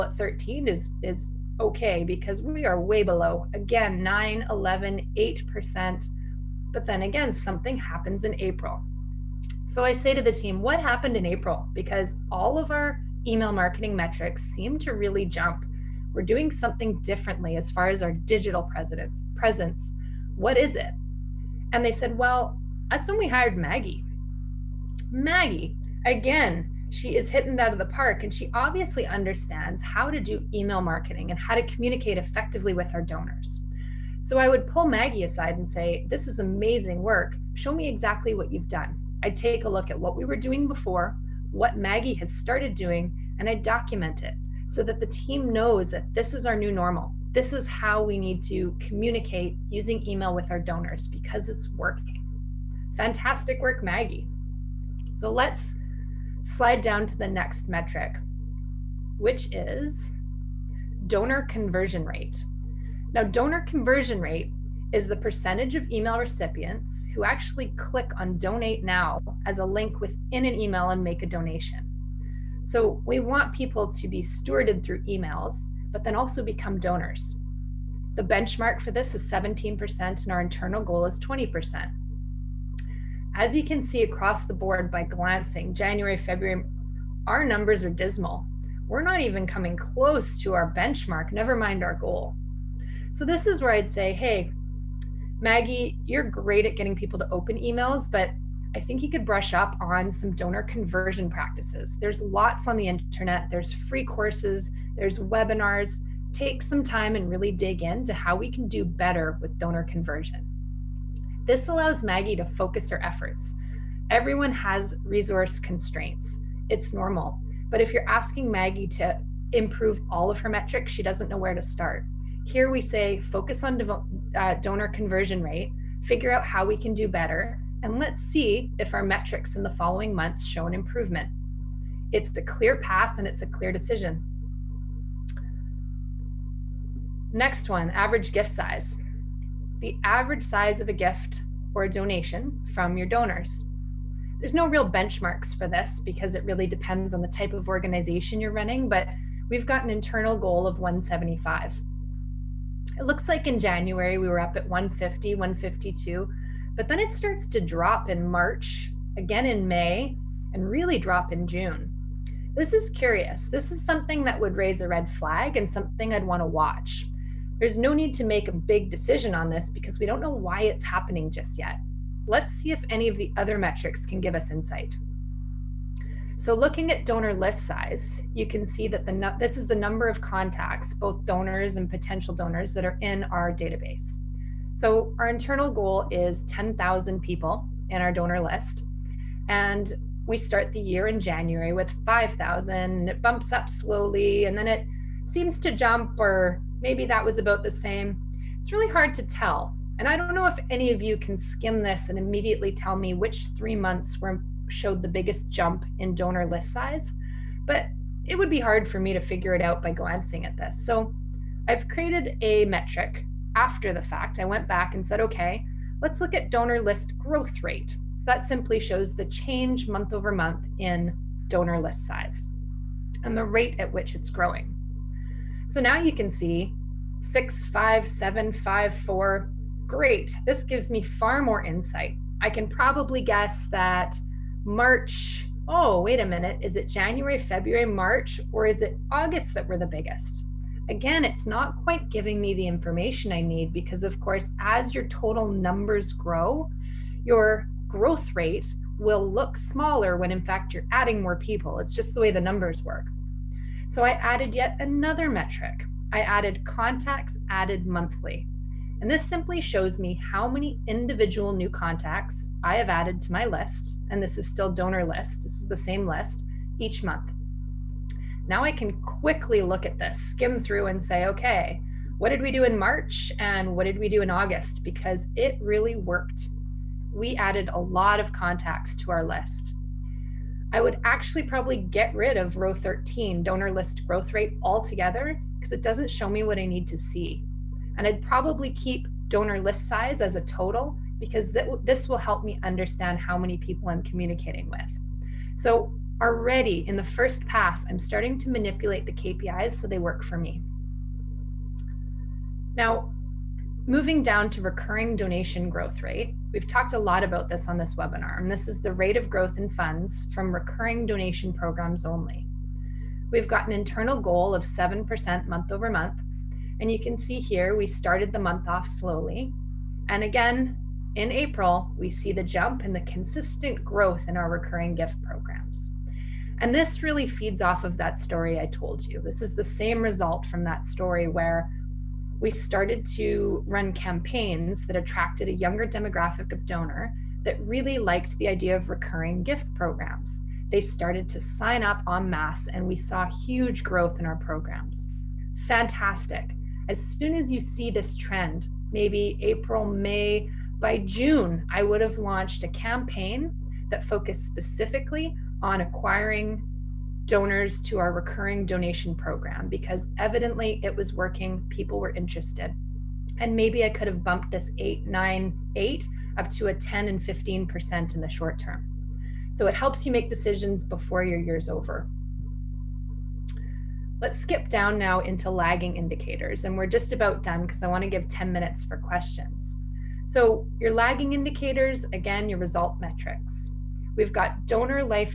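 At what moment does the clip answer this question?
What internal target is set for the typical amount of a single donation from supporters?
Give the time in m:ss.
2:30.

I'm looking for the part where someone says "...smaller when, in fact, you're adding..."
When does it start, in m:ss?
4:09.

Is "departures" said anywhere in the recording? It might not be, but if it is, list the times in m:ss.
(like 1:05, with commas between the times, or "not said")
not said.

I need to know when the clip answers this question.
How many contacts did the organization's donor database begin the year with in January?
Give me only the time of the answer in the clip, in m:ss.
3:12.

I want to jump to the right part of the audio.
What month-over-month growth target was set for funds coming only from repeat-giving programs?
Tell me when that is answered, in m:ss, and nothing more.
5:14.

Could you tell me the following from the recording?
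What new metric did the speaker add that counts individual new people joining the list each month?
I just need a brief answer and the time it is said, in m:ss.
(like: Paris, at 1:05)
contacts added monthly, at 4:16.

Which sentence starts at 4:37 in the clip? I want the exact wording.
We added a lot of contacts to our list.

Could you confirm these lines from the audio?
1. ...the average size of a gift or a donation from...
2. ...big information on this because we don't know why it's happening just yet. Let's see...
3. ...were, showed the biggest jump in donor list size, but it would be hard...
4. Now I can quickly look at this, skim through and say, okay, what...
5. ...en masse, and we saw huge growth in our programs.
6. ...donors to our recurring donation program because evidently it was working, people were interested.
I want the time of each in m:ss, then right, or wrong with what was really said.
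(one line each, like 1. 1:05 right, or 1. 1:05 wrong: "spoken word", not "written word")
1. 2:19 right
2. 2:48 wrong: "decision", not "information"
3. 3:24 right
4. 4:28 right
5. 5:42 right
6. 5:57 right.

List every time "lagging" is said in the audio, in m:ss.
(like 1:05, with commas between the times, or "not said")
6:15, 6:20.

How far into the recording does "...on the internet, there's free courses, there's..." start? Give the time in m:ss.
1:42.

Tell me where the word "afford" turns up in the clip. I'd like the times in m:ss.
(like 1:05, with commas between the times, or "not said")
not said.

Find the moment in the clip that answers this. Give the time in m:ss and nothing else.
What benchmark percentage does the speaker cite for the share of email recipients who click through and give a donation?
1:19.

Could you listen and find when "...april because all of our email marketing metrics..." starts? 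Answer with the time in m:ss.
0:11.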